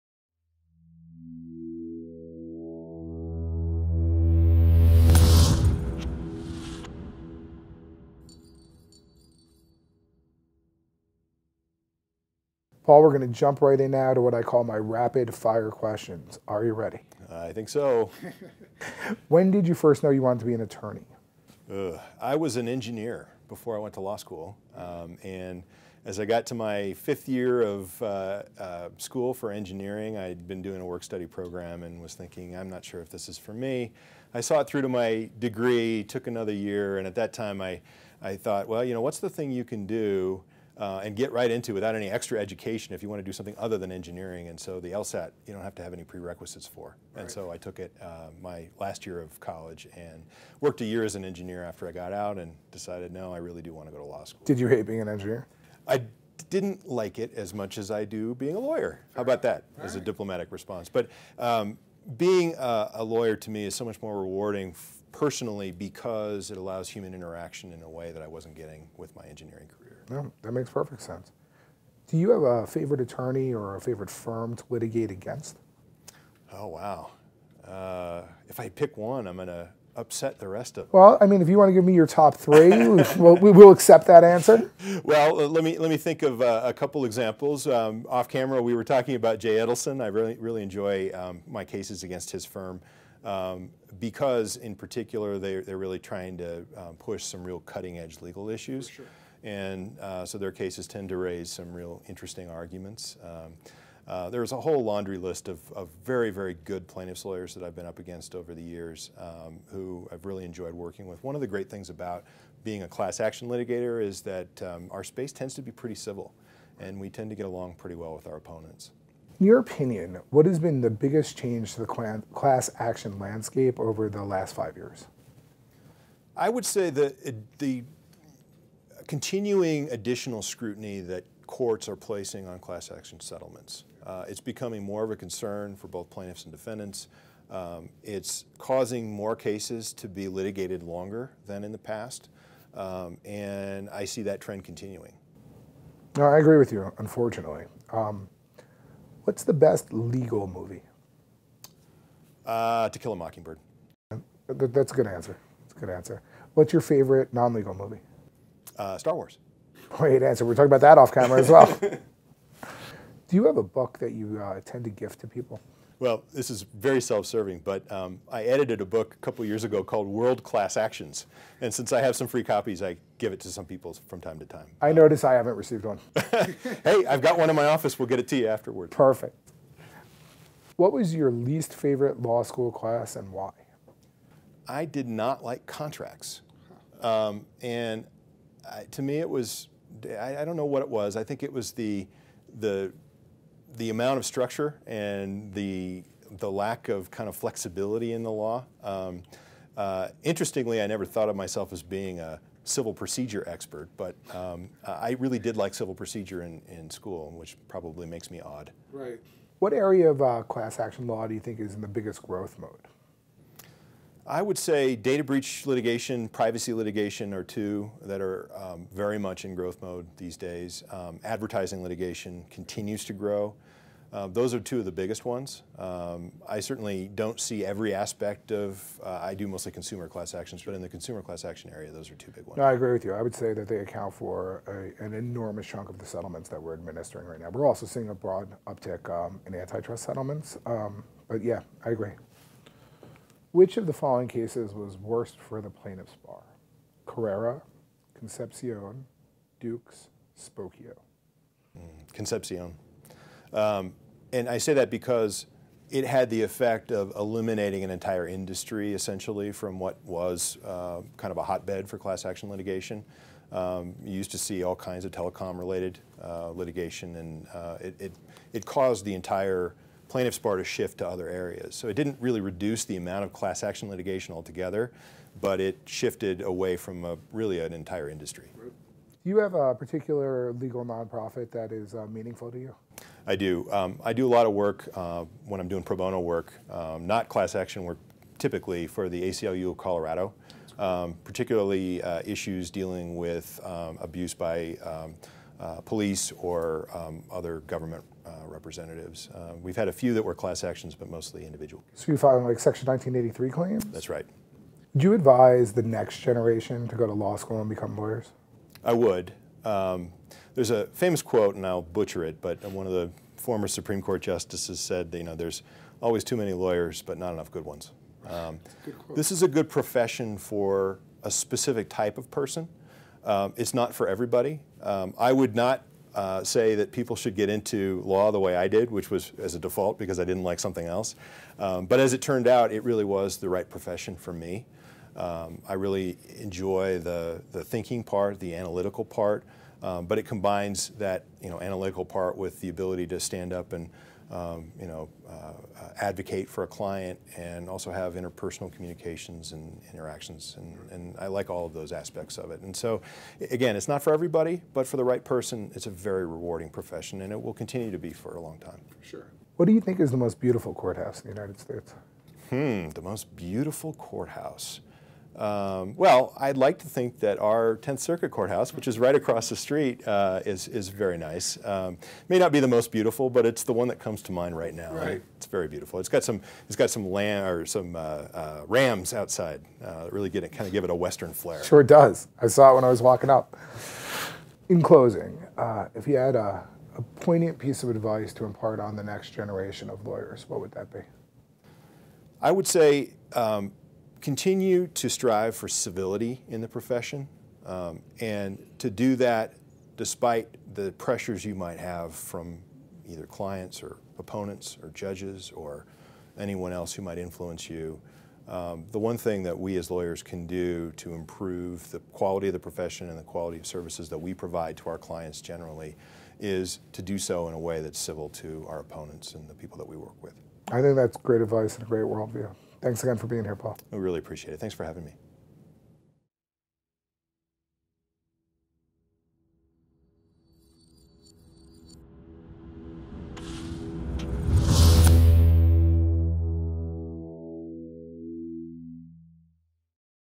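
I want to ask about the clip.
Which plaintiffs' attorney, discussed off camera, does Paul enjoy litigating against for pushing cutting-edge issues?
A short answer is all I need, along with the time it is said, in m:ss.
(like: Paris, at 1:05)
Jay Edelson, at 1:29.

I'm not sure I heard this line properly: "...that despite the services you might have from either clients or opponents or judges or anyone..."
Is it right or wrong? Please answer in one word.
wrong.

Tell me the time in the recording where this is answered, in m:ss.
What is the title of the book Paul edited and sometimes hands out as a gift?
2:50.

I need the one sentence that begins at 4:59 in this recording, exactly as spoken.
Uh, we've had a few that were class actions, but mostly individual.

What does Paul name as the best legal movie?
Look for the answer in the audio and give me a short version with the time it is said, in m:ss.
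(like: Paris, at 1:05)
To Kill a Mockingbird, at 2:32.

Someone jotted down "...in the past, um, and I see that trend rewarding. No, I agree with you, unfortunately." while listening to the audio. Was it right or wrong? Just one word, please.
wrong.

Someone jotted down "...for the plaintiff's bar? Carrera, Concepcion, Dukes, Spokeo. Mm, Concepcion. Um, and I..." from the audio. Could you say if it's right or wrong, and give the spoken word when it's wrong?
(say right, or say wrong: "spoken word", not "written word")
right.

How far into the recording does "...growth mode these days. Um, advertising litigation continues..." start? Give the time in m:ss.
3:39.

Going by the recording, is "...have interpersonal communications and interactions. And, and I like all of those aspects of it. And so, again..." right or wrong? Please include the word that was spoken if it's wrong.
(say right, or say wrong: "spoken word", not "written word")
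right.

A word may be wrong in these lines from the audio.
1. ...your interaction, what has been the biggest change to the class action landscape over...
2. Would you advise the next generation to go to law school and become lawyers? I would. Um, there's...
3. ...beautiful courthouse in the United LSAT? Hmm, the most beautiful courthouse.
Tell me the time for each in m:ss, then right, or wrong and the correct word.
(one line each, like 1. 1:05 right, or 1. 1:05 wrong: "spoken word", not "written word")
1. 1:59 wrong: "opinion", not "interaction"
2. 5:04 right
3. 6:00 wrong: "States", not "LSAT".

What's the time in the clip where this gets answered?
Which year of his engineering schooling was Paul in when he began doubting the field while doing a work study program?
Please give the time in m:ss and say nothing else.
0:26.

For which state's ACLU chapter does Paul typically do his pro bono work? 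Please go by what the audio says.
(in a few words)
Colorado.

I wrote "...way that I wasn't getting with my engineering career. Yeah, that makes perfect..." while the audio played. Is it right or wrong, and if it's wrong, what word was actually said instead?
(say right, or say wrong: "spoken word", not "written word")
right.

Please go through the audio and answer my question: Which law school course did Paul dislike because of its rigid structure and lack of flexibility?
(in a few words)
Contracts.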